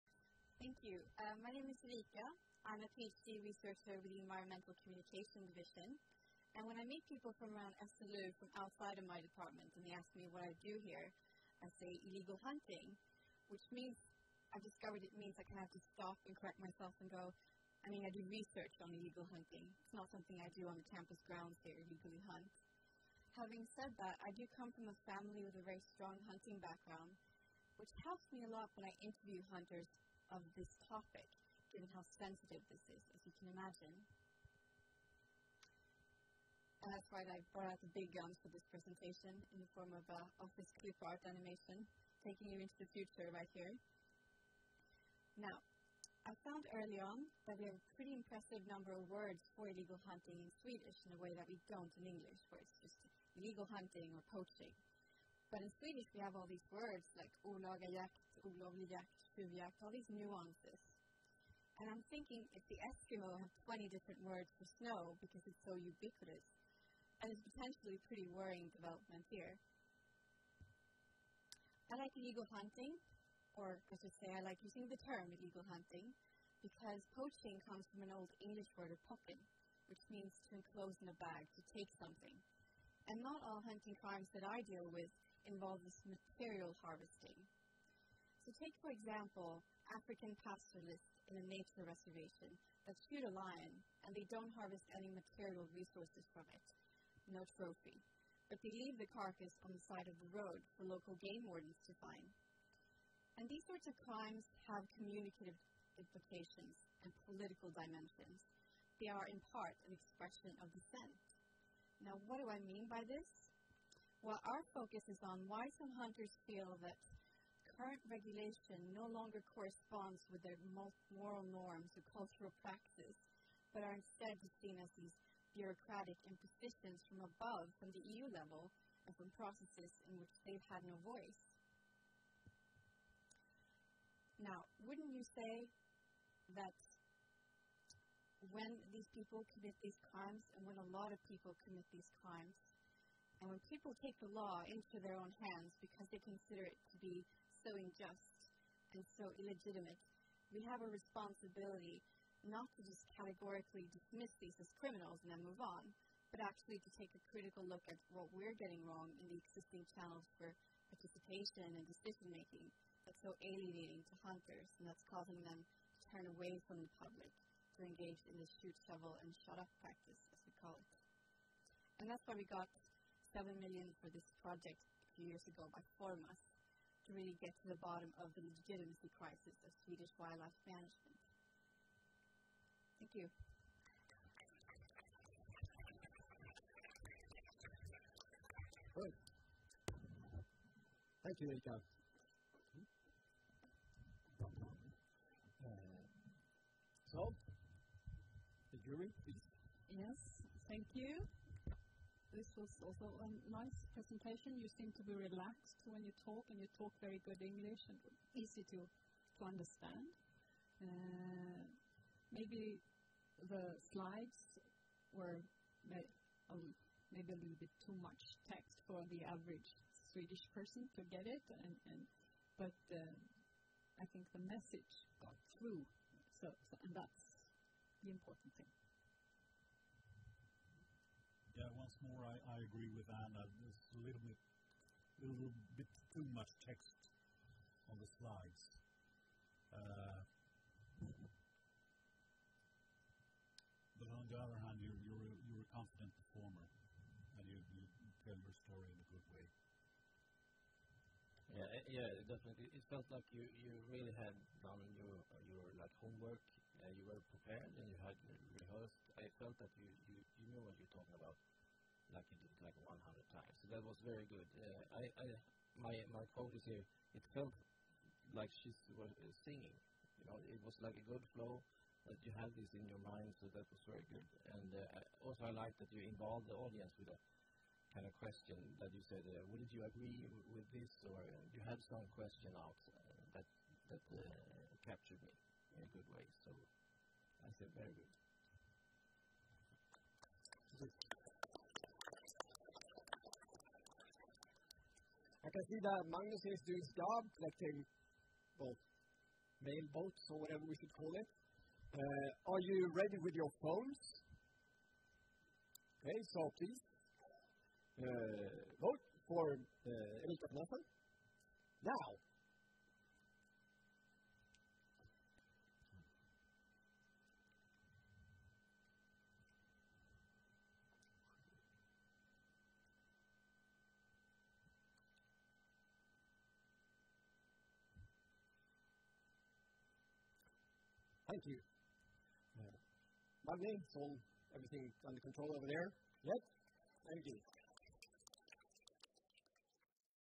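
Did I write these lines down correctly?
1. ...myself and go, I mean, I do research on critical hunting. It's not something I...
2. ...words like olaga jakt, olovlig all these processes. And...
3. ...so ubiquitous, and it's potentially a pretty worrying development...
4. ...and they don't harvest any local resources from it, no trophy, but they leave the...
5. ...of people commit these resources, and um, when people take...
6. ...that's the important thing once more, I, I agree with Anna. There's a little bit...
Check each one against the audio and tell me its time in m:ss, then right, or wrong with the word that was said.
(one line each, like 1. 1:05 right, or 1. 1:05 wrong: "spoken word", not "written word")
1. 0:16 wrong: "illegal", not "critical"
2. 0:56 wrong: "nuances", not "processes"
3. 1:05 right
4. 1:34 wrong: "material", not "local"
5. 2:21 wrong: "crimes", not "resources"
6. 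3:46 right.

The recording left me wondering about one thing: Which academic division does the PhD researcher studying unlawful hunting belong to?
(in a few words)
Environmental Communication Division.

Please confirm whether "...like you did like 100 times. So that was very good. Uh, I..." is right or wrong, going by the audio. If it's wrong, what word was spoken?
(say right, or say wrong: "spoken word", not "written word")
right.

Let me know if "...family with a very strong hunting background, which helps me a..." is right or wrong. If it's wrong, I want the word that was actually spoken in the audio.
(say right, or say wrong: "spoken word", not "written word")
right.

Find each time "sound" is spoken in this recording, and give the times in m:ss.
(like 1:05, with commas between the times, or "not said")
not said.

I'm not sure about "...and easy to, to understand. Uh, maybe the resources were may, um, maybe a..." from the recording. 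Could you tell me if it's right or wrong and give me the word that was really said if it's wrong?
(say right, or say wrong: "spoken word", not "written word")
wrong: "slides", not "resources".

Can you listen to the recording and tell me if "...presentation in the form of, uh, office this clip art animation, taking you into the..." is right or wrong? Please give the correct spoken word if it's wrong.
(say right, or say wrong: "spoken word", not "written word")
right.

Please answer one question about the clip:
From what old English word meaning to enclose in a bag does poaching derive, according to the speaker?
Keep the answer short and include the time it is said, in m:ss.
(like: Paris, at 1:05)
pocken, at 1:19.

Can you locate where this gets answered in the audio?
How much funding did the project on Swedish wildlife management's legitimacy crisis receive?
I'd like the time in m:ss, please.
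2:53.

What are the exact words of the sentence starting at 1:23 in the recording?
And not all hunting crimes that I deal with involves material harvesting.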